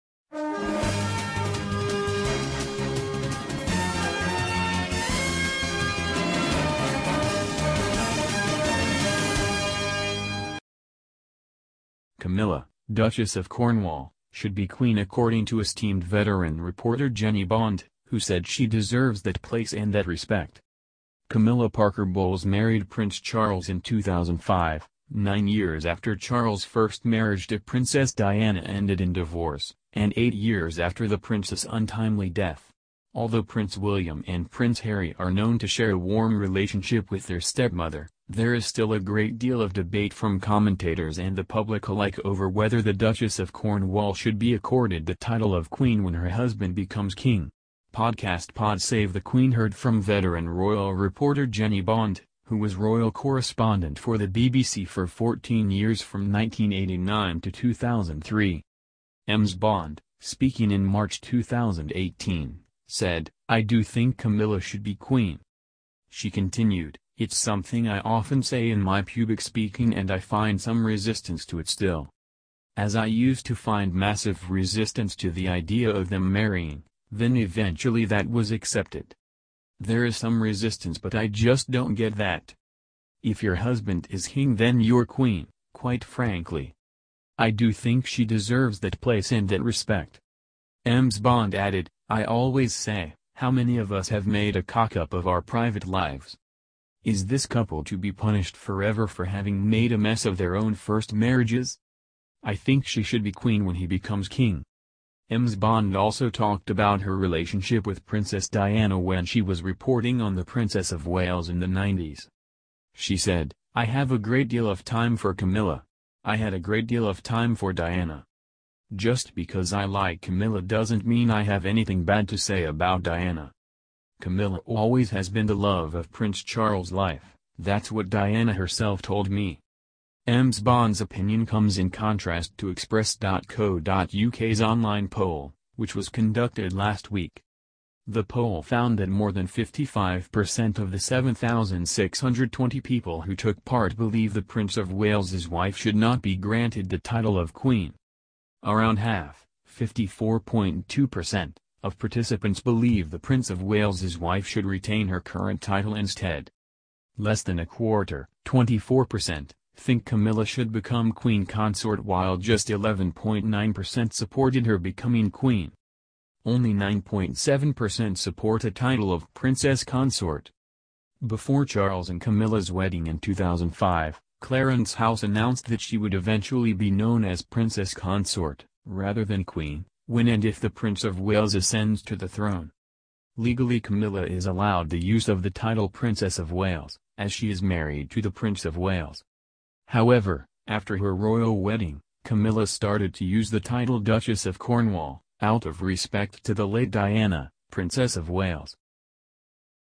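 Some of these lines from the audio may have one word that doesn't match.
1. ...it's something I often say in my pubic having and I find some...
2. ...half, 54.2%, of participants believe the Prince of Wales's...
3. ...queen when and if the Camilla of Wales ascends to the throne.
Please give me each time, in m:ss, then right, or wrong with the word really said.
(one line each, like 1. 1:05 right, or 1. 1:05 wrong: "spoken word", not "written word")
1. 1:07 wrong: "speaking", not "having"
2. 2:28 right
3. 2:59 wrong: "Prince", not "Camilla".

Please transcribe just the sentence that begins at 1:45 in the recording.
Ms Bond also talked about her relationship with Princess Diana when she was reporting on the Princess of Wales in the 90s.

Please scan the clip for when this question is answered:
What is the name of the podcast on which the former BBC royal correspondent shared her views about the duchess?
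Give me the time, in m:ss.
0:48.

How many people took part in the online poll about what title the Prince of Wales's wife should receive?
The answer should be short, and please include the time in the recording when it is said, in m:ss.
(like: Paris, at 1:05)
7,620, at 2:20.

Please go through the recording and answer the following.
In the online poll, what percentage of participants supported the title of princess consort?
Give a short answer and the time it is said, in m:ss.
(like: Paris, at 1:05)
9.7%, at 2:46.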